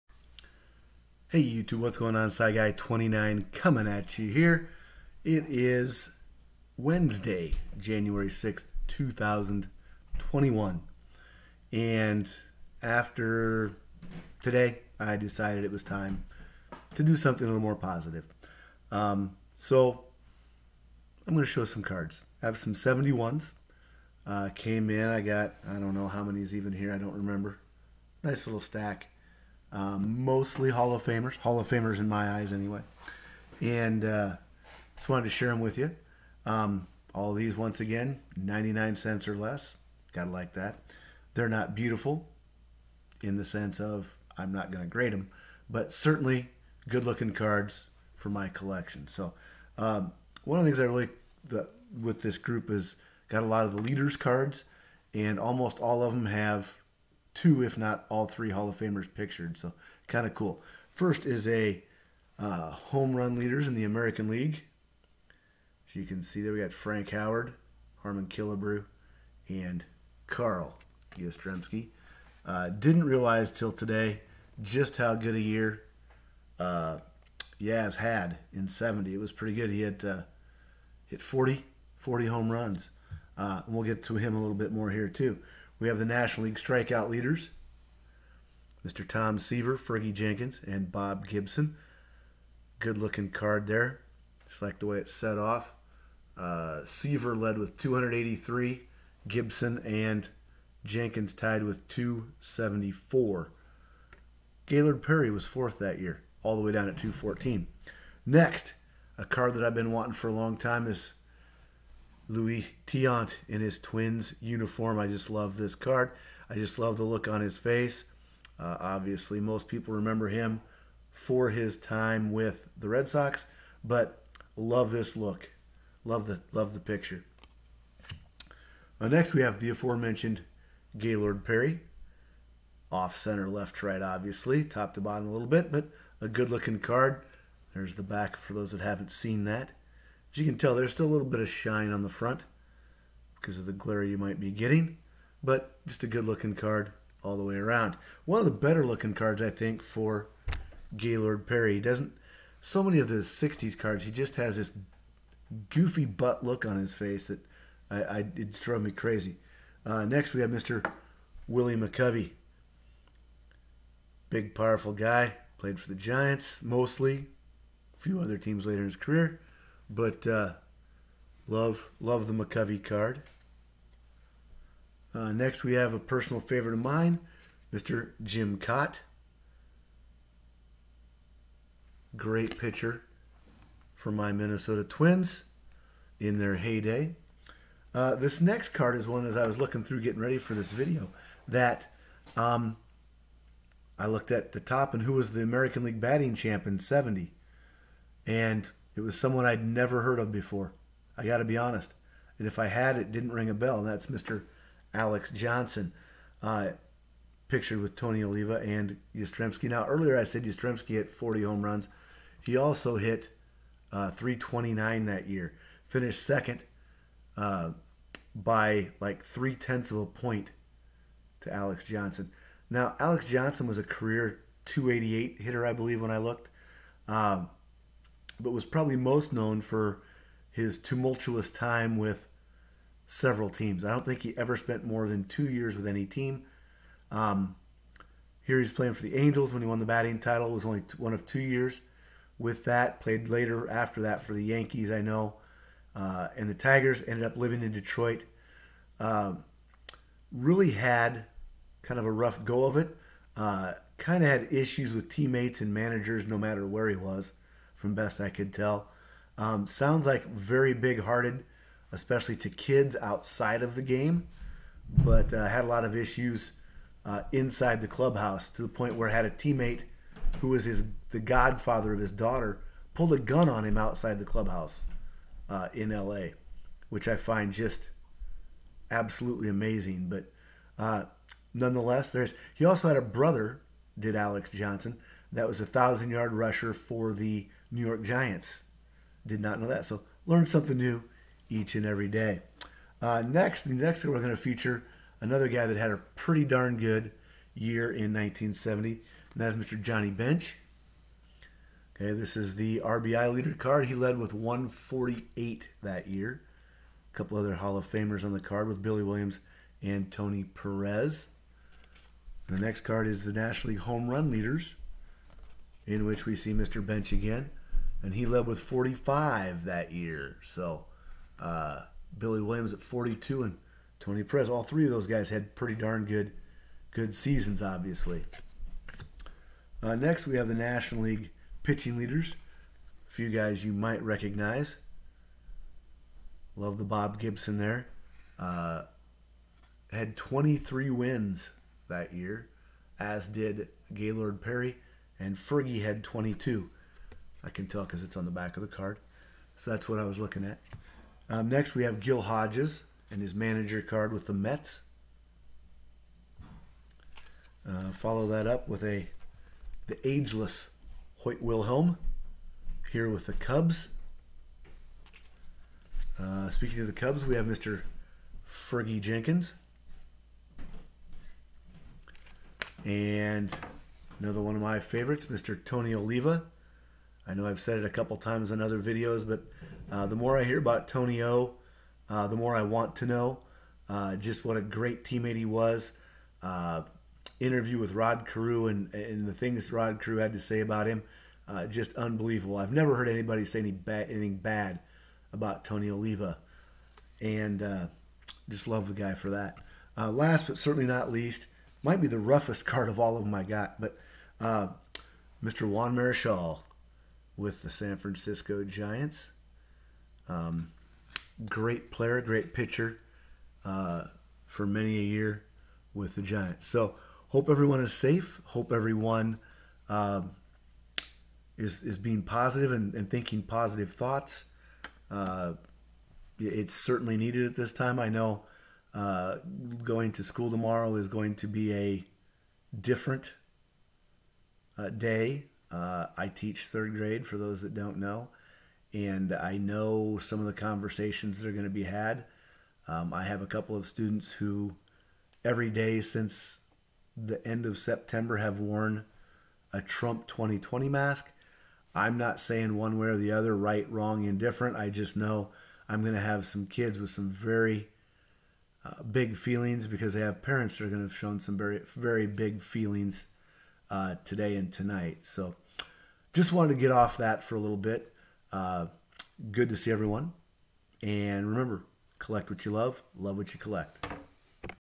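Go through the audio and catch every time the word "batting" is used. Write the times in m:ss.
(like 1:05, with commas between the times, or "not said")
3:15, 3:59.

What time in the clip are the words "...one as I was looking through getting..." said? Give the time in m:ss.
3:09.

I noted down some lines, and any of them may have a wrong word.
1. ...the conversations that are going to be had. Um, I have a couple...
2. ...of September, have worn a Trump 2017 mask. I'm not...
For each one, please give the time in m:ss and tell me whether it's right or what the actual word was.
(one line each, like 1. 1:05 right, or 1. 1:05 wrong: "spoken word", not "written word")
1. 7:20 right
2. 7:27 wrong: "2020", not "2017".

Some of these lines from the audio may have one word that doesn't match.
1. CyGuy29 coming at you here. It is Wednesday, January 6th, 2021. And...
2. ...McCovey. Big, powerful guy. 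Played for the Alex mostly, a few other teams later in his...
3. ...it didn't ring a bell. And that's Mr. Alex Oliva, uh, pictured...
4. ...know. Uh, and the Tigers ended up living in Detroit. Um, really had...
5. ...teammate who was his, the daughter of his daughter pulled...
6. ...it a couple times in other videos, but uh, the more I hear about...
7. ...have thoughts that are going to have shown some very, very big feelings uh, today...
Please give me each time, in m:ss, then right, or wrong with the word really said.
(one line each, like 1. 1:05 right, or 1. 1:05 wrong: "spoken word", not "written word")
1. 0:02 right
2. 2:41 wrong: "Giants", not "Alex"
3. 3:22 wrong: "Johnson", not "Oliva"
4. 4:05 right
5. 4:29 wrong: "godfather", not "daughter"
6. 6:17 right
7. 7:40 wrong: "parents", not "thoughts".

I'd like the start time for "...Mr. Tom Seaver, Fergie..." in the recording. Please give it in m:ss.
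1:28.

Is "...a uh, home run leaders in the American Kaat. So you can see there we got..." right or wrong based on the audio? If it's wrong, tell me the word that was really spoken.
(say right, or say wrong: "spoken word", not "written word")
wrong: "League", not "Kaat".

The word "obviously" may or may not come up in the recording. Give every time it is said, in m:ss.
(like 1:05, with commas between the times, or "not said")
1:58, 2:14, 5:27.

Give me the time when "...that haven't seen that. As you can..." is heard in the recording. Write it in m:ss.
2:18.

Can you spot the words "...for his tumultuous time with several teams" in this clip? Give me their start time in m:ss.
3:49.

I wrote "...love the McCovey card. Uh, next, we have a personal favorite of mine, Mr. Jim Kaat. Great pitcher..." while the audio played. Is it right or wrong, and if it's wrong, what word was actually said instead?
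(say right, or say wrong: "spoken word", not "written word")
right.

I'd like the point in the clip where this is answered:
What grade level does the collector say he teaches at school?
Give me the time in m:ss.
7:16.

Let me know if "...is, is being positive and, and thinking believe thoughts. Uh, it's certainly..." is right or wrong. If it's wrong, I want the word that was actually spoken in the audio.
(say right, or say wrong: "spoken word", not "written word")
wrong: "positive", not "believe".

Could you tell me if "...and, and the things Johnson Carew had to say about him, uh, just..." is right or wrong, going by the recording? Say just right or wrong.
wrong.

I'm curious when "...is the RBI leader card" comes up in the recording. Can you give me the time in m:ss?
5:02.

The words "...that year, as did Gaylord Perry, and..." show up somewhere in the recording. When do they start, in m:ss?
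5:41.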